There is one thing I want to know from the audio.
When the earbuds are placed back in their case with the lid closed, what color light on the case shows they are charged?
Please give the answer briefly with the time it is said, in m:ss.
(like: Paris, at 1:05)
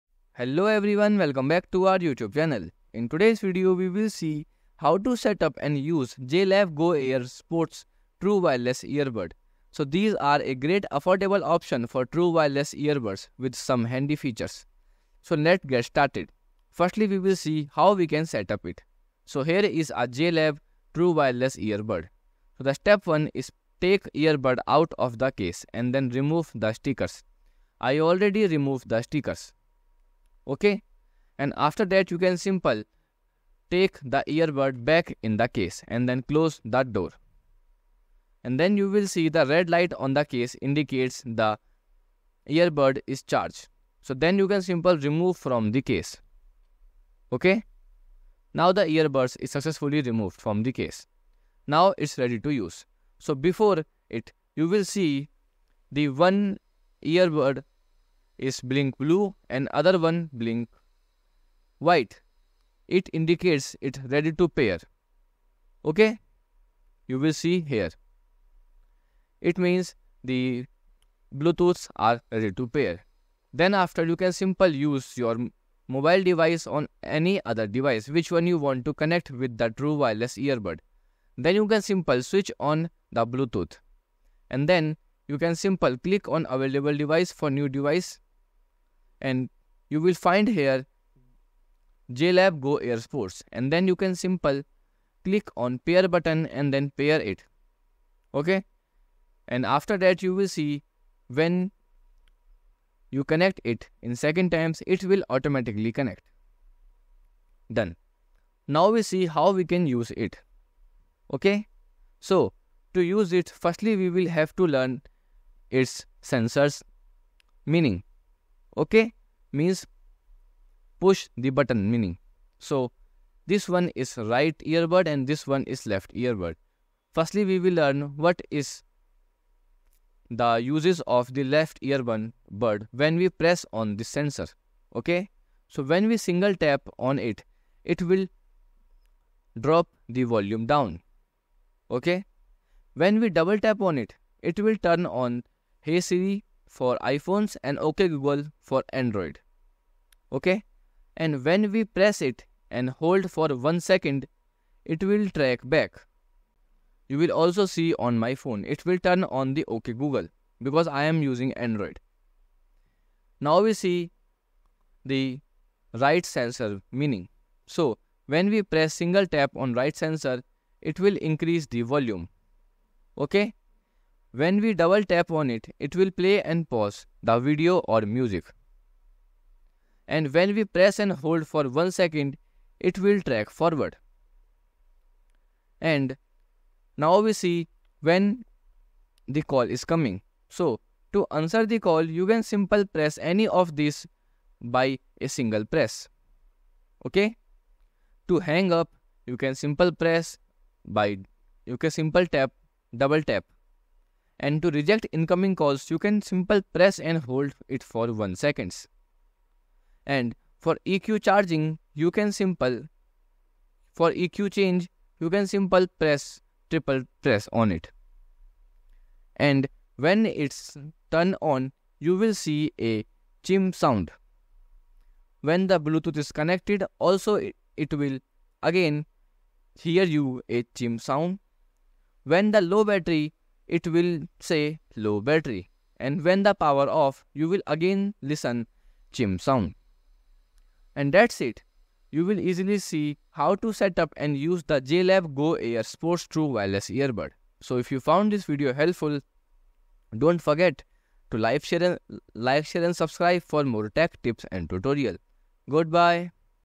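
Red, at 0:39.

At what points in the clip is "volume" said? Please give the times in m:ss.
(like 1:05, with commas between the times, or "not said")
2:20, 2:51.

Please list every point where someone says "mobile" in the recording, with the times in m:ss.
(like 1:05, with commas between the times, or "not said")
1:15.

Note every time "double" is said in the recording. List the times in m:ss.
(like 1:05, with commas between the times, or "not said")
2:23, 2:54, 3:22.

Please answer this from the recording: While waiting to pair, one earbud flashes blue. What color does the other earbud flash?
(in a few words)
White.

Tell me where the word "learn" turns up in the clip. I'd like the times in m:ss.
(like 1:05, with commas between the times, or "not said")
1:54, 2:07.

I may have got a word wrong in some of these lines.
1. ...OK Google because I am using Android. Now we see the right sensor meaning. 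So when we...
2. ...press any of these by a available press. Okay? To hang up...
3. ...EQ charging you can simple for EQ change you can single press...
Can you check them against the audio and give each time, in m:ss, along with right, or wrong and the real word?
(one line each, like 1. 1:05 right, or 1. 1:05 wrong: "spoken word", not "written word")
1. 2:39 right
2. 3:12 wrong: "single", not "available"
3. 3:30 wrong: "simple", not "single".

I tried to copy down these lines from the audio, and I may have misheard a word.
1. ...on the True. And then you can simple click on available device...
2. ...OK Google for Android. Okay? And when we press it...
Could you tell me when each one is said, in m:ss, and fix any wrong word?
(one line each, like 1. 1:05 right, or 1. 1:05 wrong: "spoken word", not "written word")
1. 1:22 wrong: "Bluetooth", not "True"
2. 2:27 right.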